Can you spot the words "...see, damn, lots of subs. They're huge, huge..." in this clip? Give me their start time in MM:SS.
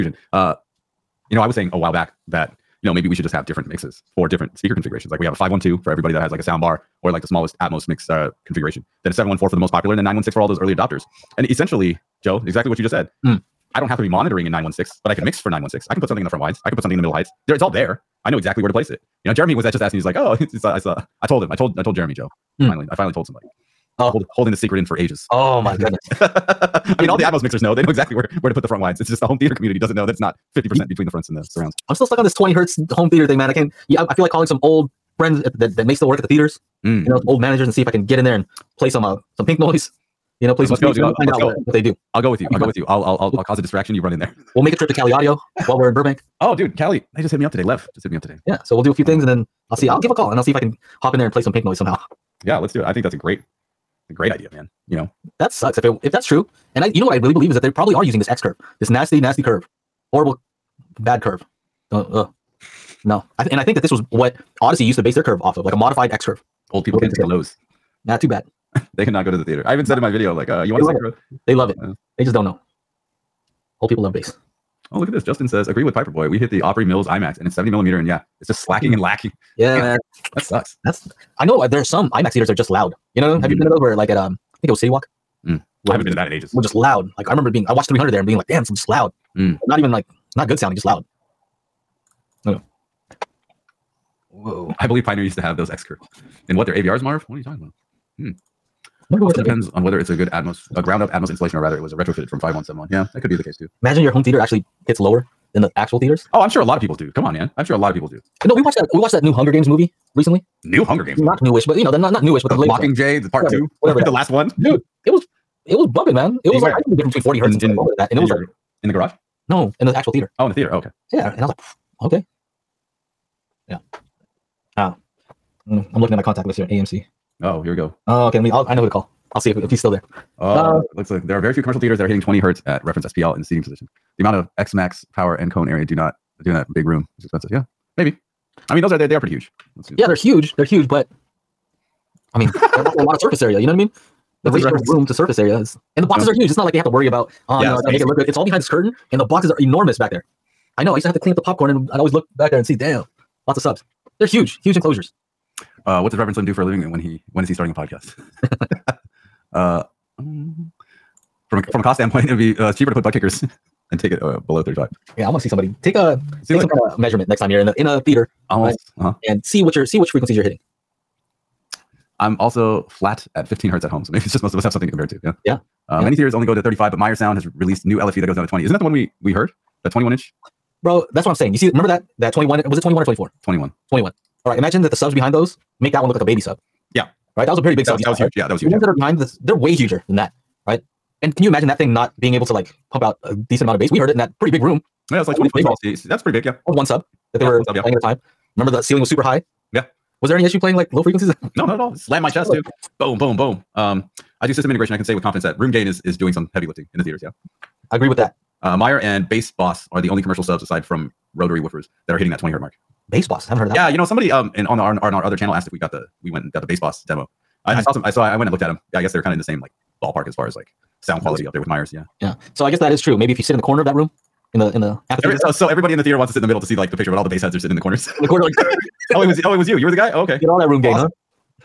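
02:32.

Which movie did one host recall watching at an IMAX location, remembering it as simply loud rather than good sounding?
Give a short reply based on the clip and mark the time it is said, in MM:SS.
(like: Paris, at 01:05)
300, at 01:27.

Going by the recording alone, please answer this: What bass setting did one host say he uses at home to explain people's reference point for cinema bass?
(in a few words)
Flat at 15 hertz.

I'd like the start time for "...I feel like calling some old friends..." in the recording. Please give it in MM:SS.
00:34.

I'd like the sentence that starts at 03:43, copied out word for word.
Maybe if you sit in the corner of that room, in the in the apathy.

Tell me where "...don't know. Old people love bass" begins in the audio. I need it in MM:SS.
01:12.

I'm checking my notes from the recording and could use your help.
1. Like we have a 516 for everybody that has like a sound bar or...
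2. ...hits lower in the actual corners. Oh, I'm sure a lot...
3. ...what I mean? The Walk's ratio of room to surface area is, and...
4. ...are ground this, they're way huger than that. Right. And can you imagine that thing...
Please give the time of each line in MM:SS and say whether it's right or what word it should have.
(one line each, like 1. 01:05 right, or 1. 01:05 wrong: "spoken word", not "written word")
1. 00:05 wrong: "512", not "516"
2. 01:44 wrong: "theaters", not "corners"
3. 02:23 wrong: "What", not "Walk"
4. 03:08 wrong: "behind", not "ground".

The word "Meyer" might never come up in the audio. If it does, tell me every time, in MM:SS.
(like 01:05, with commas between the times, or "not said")
02:56, 03:28.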